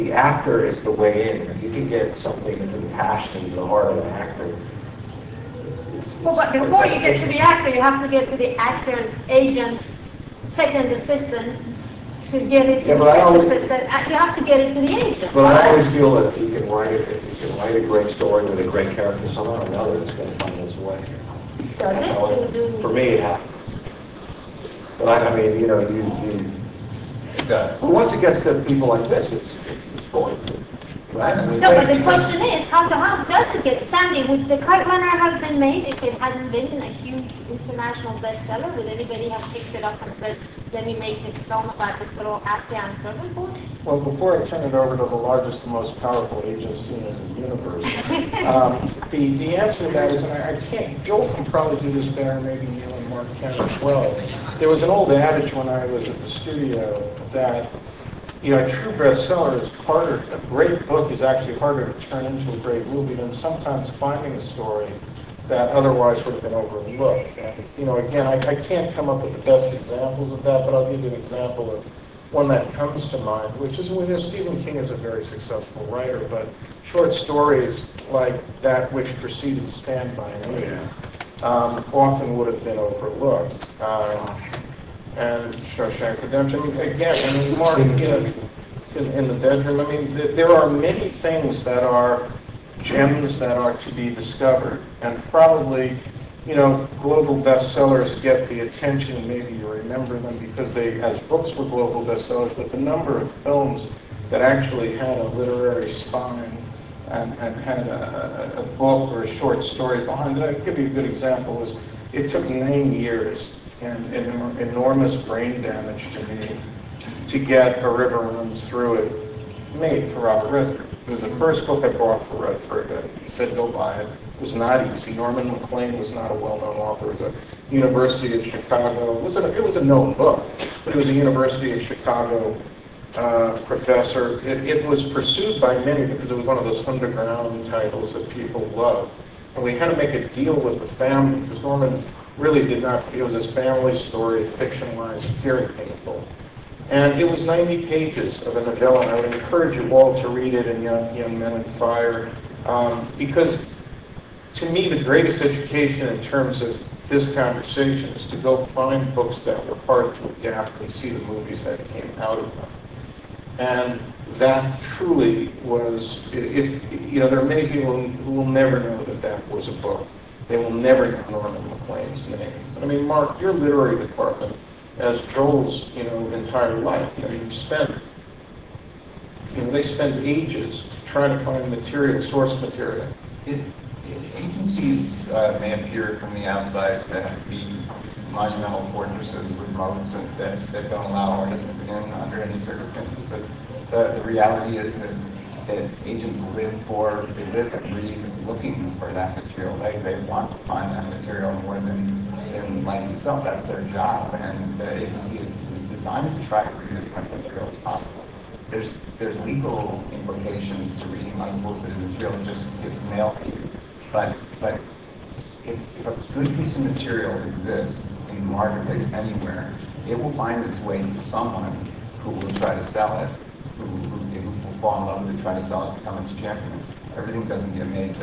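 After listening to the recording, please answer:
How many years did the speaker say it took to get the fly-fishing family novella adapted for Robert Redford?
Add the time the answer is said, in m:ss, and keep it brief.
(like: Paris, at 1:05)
9, at 1:52.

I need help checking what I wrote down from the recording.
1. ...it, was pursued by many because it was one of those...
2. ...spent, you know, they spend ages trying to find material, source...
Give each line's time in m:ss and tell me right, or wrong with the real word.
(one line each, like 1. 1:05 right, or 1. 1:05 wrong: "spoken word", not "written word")
1. 2:14 right
2. 2:57 right.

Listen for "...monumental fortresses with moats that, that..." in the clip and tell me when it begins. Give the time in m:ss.
3:08.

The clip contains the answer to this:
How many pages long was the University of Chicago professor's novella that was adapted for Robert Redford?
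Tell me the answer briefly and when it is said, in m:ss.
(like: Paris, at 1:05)
90, at 2:27.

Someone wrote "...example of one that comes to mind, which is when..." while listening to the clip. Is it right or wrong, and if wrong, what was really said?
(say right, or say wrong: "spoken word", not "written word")
right.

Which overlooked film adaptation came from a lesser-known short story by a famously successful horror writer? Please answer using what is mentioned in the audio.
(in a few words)
Stand By Me.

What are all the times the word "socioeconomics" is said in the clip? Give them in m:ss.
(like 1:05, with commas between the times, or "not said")
1:25.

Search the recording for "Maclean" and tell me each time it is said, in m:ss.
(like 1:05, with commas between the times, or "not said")
2:05, 2:51.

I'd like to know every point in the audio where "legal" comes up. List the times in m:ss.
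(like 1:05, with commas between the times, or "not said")
3:29.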